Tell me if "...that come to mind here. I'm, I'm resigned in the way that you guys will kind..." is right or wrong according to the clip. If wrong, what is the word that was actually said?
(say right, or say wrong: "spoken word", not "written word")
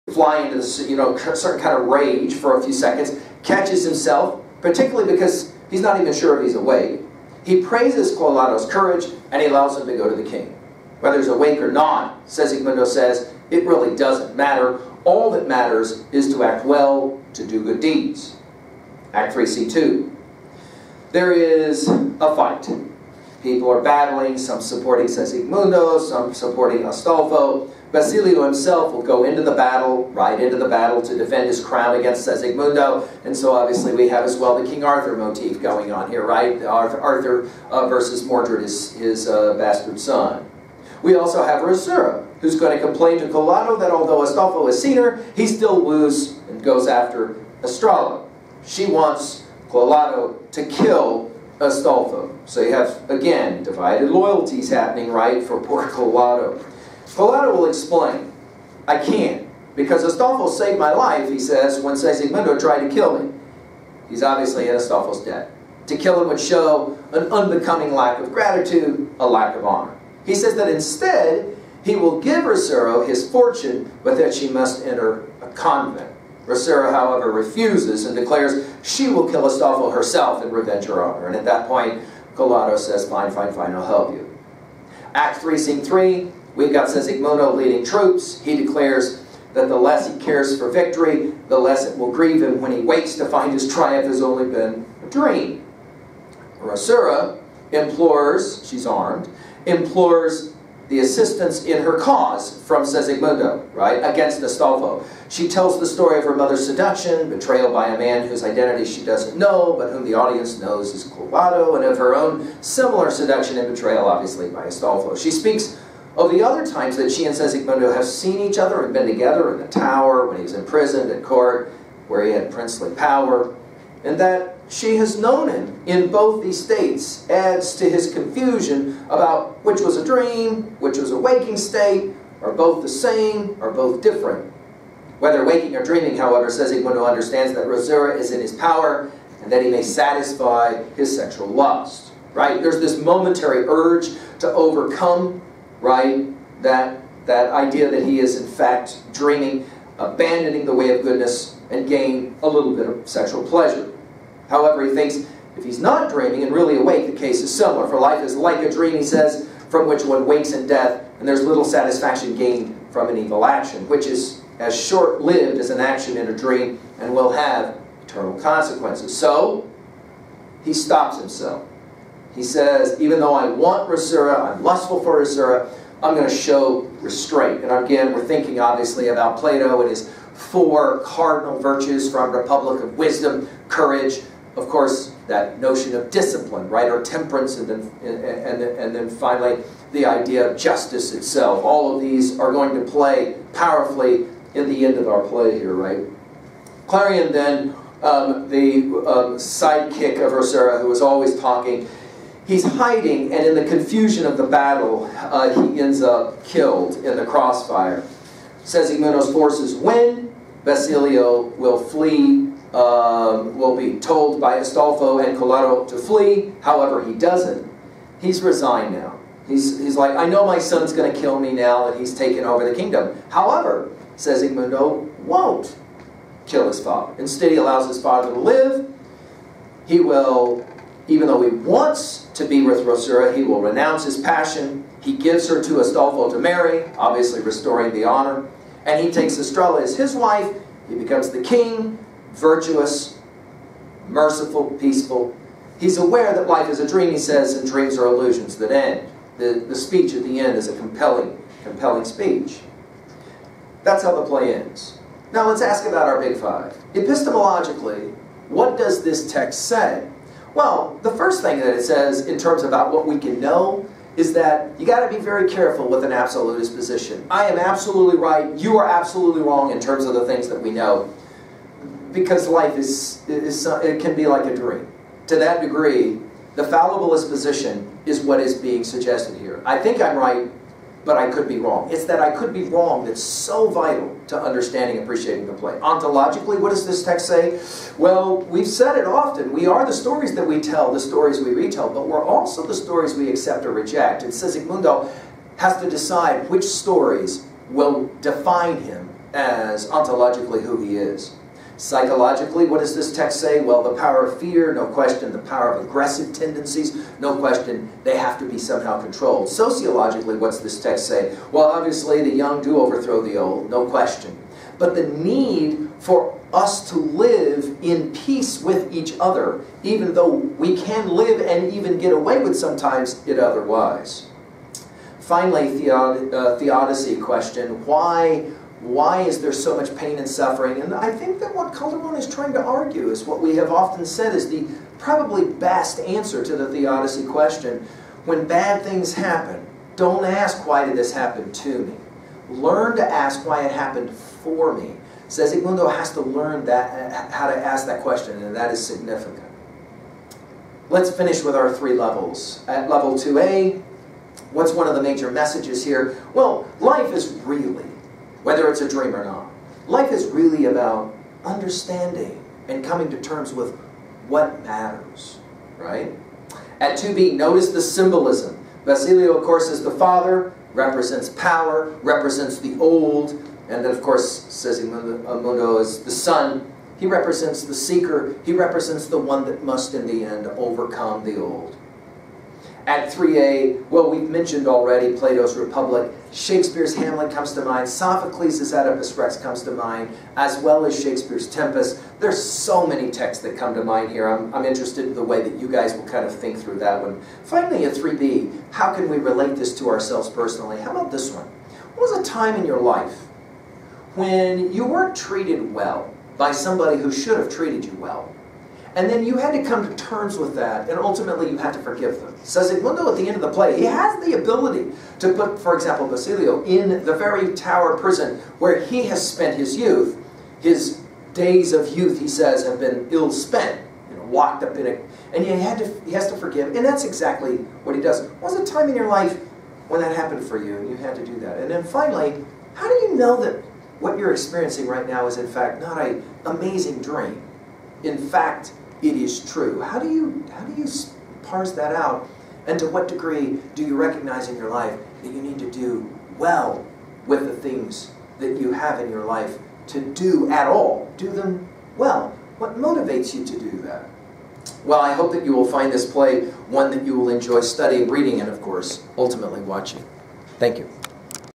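wrong: "interested", not "resigned".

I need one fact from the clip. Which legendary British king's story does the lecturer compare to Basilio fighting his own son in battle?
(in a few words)
King Arthur.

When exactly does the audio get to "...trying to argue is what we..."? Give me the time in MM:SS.
05:32.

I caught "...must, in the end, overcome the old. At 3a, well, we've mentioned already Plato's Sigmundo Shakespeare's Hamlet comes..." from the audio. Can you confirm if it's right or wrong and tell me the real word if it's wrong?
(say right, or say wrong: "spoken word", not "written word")
wrong: "Republic", not "Sigmundo".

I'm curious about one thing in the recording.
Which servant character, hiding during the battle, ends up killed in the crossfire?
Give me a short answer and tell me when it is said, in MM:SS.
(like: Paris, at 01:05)
Clarion, at 03:16.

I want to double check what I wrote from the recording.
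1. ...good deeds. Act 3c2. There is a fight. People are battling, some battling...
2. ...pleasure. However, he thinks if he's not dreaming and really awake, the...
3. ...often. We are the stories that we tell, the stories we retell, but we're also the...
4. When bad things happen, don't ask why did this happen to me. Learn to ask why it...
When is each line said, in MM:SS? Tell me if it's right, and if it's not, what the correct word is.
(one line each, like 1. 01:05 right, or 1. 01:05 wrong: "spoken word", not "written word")
1. 00:17 wrong: "supporting", not "battling"
2. 02:33 right
3. 04:49 right
4. 05:38 right.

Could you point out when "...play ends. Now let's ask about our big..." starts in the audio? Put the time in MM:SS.
04:14.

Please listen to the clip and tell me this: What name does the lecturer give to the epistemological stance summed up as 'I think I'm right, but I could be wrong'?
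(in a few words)
Fallibilist position.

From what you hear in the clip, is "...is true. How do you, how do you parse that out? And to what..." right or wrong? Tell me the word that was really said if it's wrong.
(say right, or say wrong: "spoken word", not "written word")
right.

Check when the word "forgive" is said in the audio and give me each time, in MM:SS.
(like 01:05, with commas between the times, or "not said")
06:51, 07:06.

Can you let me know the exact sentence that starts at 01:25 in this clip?
Act 3, scene 3, We've got Sesigmundo leading troops.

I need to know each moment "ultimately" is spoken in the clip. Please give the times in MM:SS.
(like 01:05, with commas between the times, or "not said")
06:50, 07:39.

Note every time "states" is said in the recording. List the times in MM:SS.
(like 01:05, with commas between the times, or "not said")
02:06, 02:11.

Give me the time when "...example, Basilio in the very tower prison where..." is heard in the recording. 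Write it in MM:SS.
06:55.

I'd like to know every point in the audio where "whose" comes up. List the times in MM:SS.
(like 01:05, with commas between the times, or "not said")
01:48.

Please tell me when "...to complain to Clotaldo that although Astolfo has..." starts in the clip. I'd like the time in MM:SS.
00:42.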